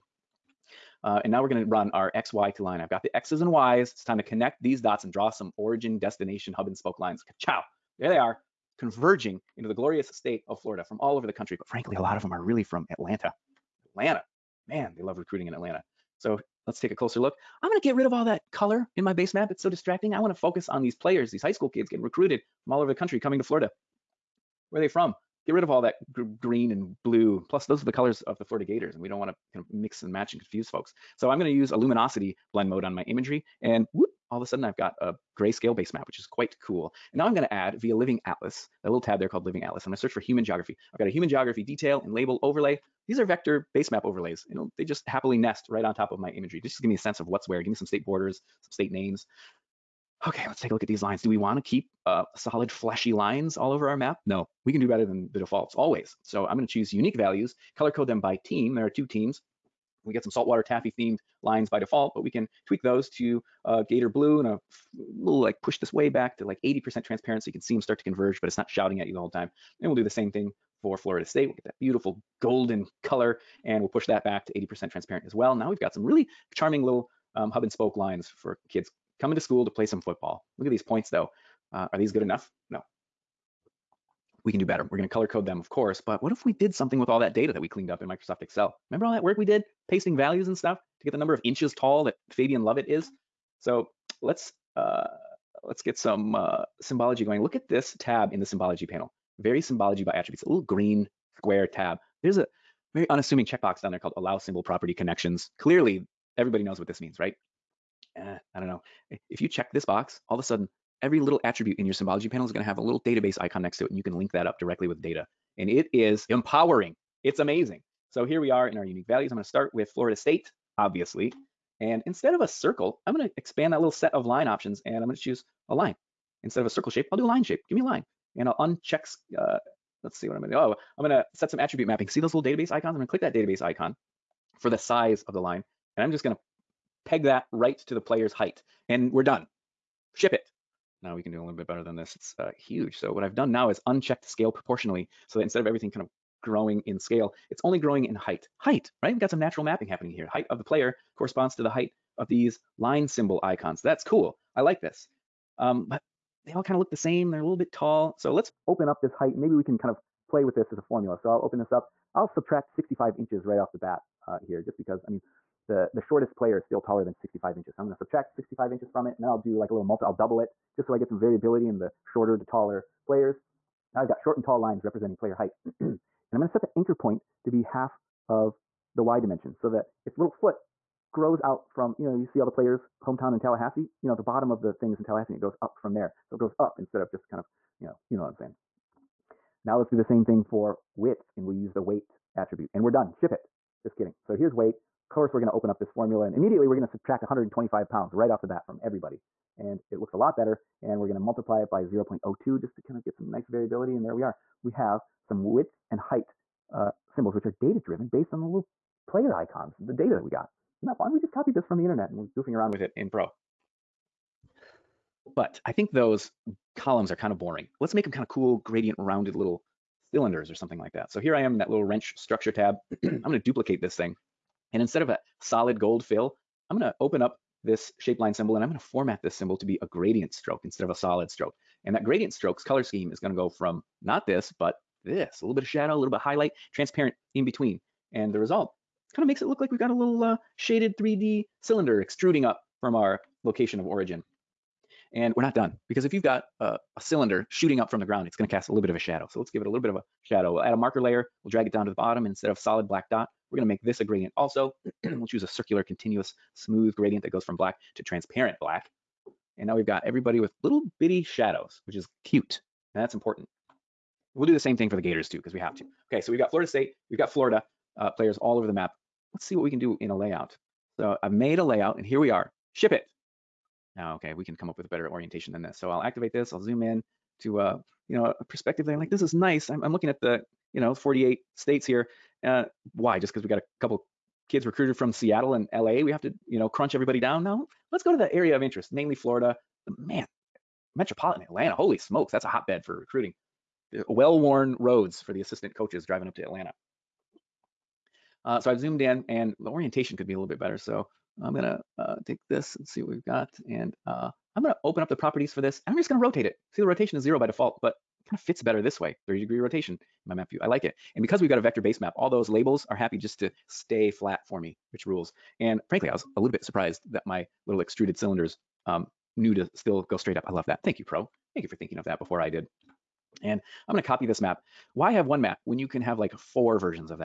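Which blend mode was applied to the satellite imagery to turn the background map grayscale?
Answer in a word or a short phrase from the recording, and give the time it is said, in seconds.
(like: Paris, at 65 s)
Luminosity, at 31 s.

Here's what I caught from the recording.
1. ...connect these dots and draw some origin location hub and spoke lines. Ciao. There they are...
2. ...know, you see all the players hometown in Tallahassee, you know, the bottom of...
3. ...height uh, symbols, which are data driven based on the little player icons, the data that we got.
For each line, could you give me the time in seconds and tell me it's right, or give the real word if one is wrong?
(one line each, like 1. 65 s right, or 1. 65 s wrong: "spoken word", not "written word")
1. 4 s wrong: "destination", not "location"
2. 182 s right
3. 205 s right.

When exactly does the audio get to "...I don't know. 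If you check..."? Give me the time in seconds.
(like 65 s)
108 s.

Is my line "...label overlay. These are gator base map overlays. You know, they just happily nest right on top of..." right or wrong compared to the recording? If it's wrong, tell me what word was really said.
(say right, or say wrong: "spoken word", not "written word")
wrong: "vector", not "gator".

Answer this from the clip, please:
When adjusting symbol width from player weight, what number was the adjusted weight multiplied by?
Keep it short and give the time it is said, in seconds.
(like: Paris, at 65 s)
0.02, at 201 s.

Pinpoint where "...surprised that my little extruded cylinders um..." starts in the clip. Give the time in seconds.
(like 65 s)
316 s.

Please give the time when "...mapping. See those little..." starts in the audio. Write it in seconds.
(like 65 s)
131 s.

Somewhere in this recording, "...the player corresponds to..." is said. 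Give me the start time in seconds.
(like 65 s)
150 s.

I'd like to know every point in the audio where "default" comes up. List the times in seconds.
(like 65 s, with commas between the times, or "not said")
55 s, 61 s, 307 s.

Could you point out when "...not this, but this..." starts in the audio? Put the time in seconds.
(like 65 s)
234 s.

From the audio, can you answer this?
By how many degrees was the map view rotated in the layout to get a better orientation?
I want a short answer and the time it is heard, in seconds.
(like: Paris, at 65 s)
30, at 309 s.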